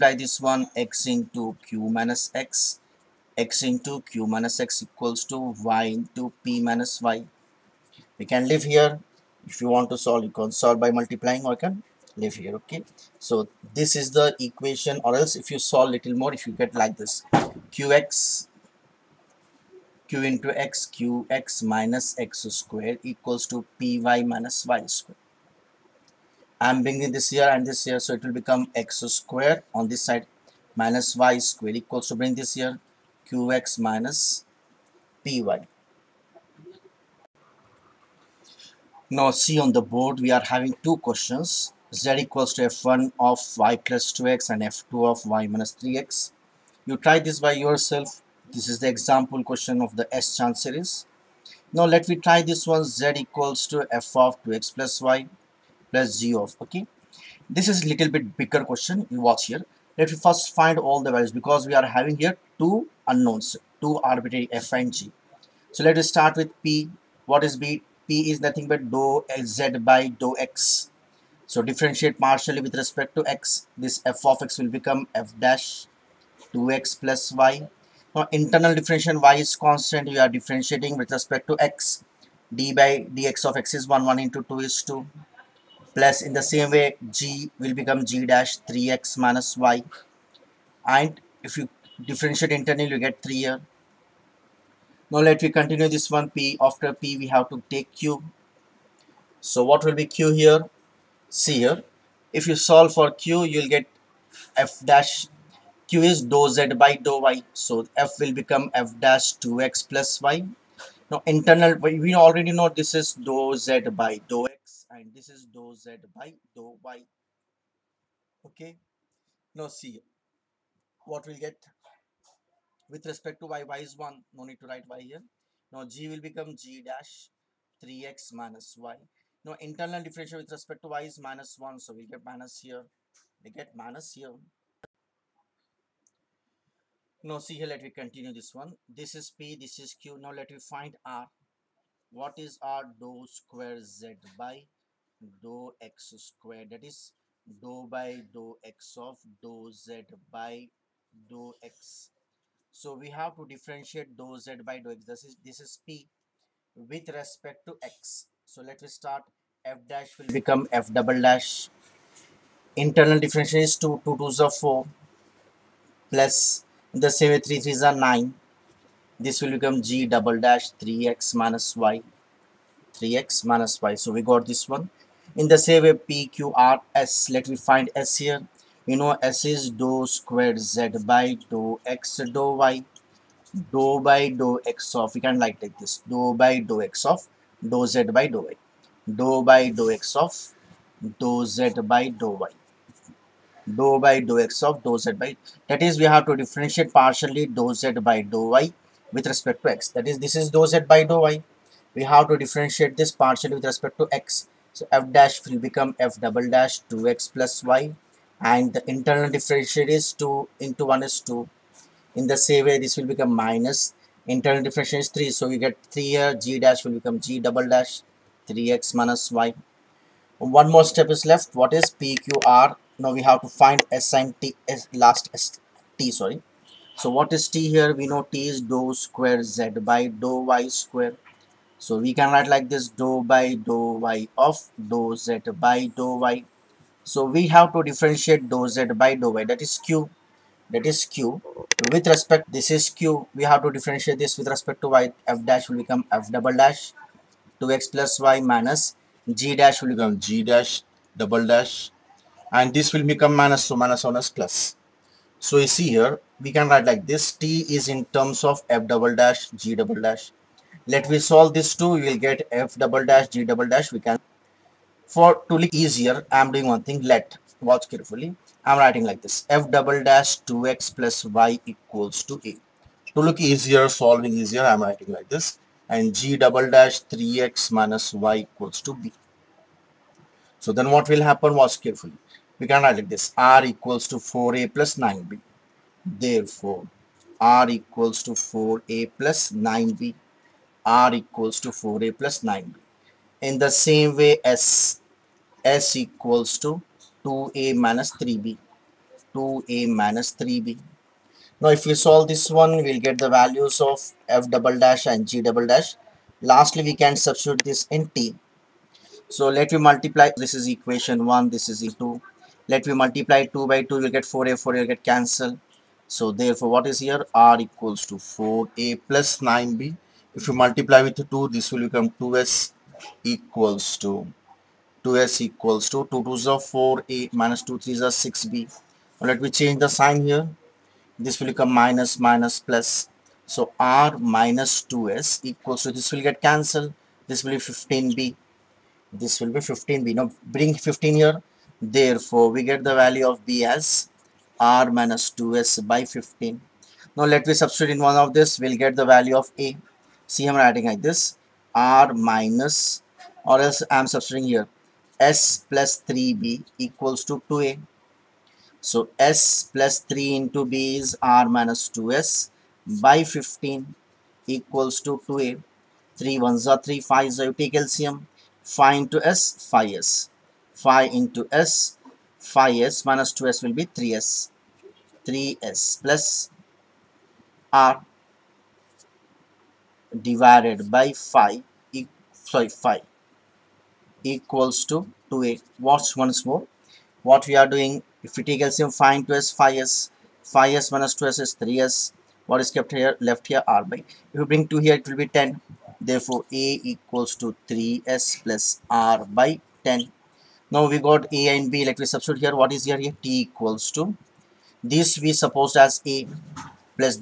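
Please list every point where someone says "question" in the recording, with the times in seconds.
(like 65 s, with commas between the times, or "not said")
41 s, 49 s, 58 s.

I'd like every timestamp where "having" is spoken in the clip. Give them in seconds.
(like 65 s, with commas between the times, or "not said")
40 s, 61 s.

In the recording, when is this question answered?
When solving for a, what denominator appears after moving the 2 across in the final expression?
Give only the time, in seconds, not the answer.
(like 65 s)
395 s.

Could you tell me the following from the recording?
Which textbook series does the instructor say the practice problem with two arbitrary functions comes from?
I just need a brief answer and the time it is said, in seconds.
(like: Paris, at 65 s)
S Chand series, at 50 s.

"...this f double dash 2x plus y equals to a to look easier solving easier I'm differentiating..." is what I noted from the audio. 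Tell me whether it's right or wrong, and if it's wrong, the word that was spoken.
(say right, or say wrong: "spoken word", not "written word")
wrong: "writing", not "differentiating".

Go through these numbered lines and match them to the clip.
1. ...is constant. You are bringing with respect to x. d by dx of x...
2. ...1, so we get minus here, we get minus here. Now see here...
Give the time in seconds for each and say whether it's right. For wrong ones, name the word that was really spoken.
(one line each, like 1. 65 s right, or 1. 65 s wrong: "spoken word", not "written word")
1. 79 s wrong: "differentiating", not "bringing"
2. 131 s right.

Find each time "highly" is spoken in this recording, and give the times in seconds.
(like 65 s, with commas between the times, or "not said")
not said.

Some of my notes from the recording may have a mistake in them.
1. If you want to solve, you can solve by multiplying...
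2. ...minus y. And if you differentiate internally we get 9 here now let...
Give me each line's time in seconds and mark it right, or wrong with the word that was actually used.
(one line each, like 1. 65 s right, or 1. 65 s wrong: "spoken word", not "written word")
1. 9 s right
2. 89 s wrong: "3", not "9".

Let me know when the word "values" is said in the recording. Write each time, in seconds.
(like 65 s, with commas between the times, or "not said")
61 s, 303 s, 343 s, 349 s.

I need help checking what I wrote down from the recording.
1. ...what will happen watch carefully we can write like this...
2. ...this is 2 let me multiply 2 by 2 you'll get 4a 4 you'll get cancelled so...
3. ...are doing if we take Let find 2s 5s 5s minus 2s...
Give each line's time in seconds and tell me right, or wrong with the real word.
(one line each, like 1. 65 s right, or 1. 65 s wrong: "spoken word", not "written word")
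1. 280 s right
2. 311 s right
3. 387 s wrong: "LCM", not "Let".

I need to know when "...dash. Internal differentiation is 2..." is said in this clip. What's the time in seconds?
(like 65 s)
161 s.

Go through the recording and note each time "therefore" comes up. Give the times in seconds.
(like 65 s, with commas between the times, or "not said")
286 s, 316 s, 341 s, 396 s.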